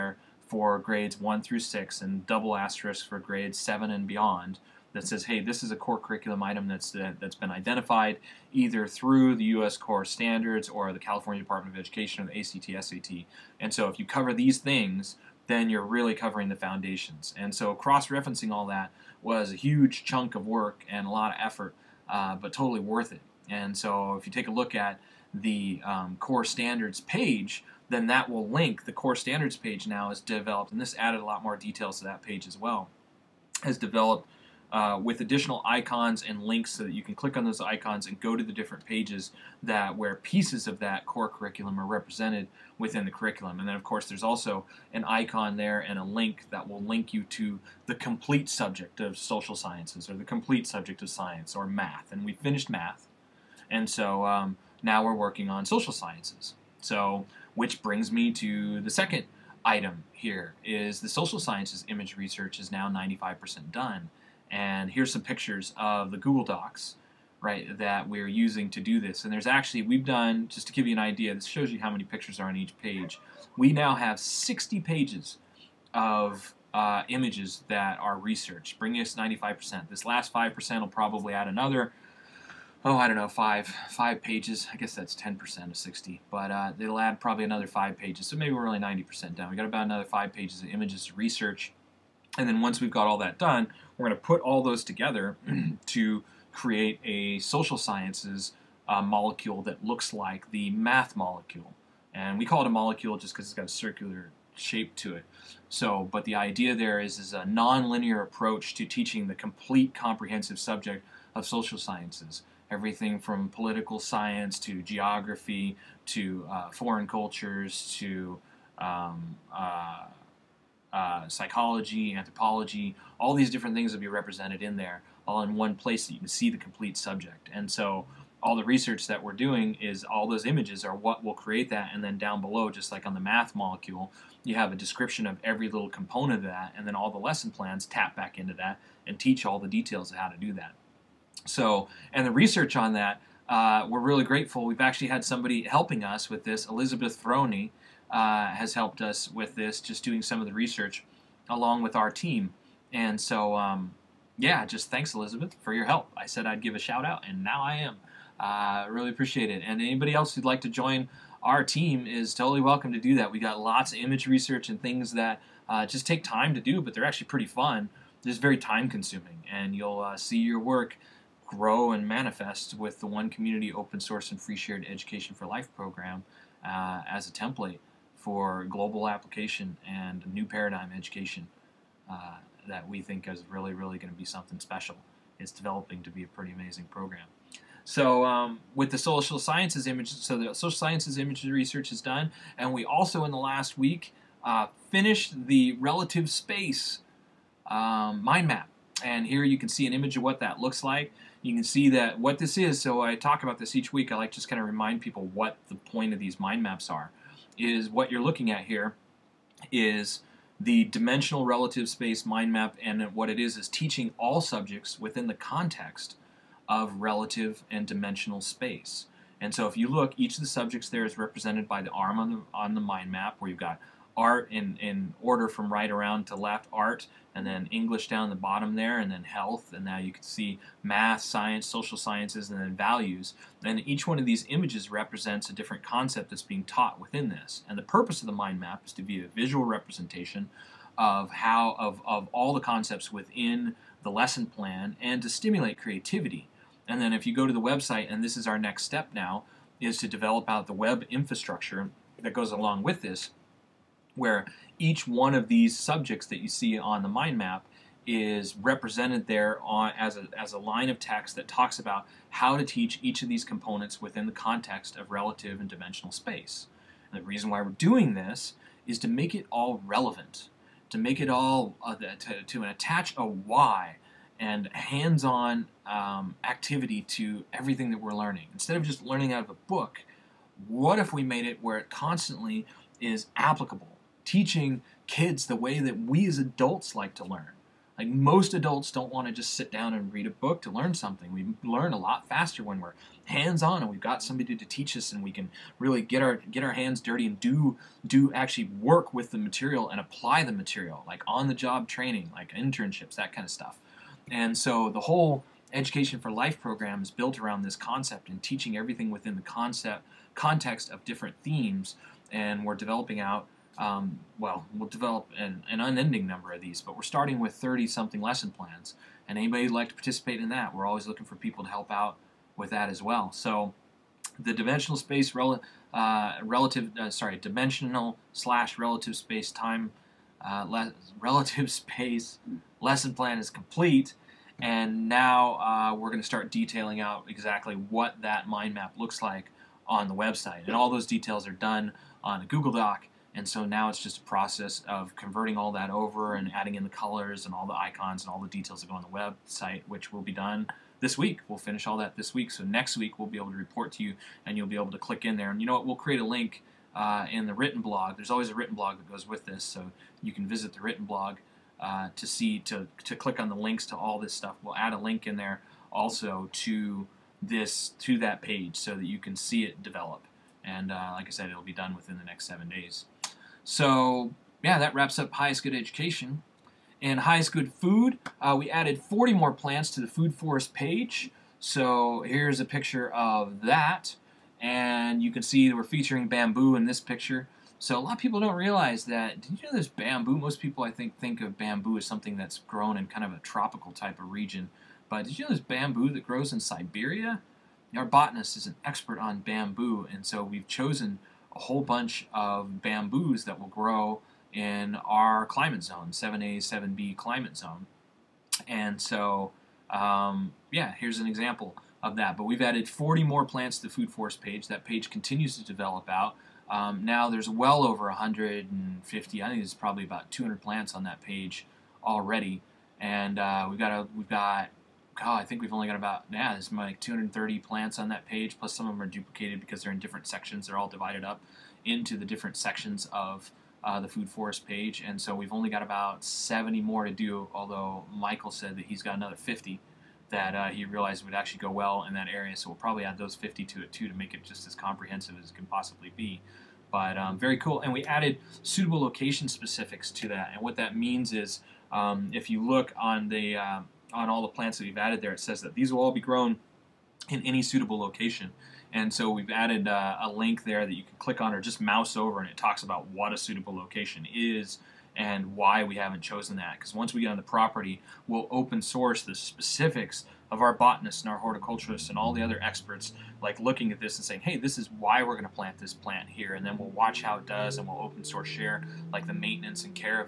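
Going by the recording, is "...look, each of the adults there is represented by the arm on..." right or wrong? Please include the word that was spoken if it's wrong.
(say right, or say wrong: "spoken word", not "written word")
wrong: "subjects", not "adults".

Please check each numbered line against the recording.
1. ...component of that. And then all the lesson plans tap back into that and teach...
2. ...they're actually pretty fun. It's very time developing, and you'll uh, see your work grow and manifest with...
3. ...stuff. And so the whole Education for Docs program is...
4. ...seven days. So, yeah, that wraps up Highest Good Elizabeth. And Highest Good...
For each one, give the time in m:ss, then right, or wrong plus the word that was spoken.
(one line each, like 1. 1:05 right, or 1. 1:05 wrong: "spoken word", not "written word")
1. 2:15 right
2. 2:46 wrong: "consuming", not "developing"
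3. 5:03 wrong: "Life", not "Docs"
4. 6:12 wrong: "Education", not "Elizabeth".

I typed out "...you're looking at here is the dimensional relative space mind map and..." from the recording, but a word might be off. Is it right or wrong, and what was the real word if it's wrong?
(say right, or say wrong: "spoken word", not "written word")
right.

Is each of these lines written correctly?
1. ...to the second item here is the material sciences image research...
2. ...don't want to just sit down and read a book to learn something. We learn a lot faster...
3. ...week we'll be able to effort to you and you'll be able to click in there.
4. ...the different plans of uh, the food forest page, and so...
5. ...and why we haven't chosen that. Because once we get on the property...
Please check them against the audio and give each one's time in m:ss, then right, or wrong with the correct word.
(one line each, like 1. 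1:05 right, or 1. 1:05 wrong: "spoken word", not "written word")
1. 0:58 wrong: "social", not "material"
2. 4:48 right
3. 5:52 wrong: "report", not "effort"
4. 7:12 wrong: "sections", not "plans"
5. 7:45 right.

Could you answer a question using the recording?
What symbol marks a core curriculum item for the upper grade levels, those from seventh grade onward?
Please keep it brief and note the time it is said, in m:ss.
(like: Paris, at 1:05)
Double asterisk, at 0:02.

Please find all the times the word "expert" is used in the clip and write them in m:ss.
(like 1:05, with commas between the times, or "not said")
6:38, 7:52.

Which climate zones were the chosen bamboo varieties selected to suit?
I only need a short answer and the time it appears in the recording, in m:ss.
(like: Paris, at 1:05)
7A, 7B, at 6:46.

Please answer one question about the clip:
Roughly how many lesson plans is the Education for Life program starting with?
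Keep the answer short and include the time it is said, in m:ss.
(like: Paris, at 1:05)
30 something, at 5:17.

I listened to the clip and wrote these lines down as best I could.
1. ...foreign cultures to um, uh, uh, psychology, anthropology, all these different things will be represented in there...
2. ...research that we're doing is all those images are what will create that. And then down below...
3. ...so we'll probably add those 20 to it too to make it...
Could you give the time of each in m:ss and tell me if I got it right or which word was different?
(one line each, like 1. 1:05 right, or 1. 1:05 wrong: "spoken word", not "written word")
1. 1:56 right
2. 2:08 right
3. 7:22 wrong: "50", not "20".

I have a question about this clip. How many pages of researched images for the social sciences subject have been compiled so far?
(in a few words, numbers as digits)
60.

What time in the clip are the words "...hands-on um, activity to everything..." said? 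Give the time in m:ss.
4:34.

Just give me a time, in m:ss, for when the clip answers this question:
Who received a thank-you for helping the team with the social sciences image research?
2:26.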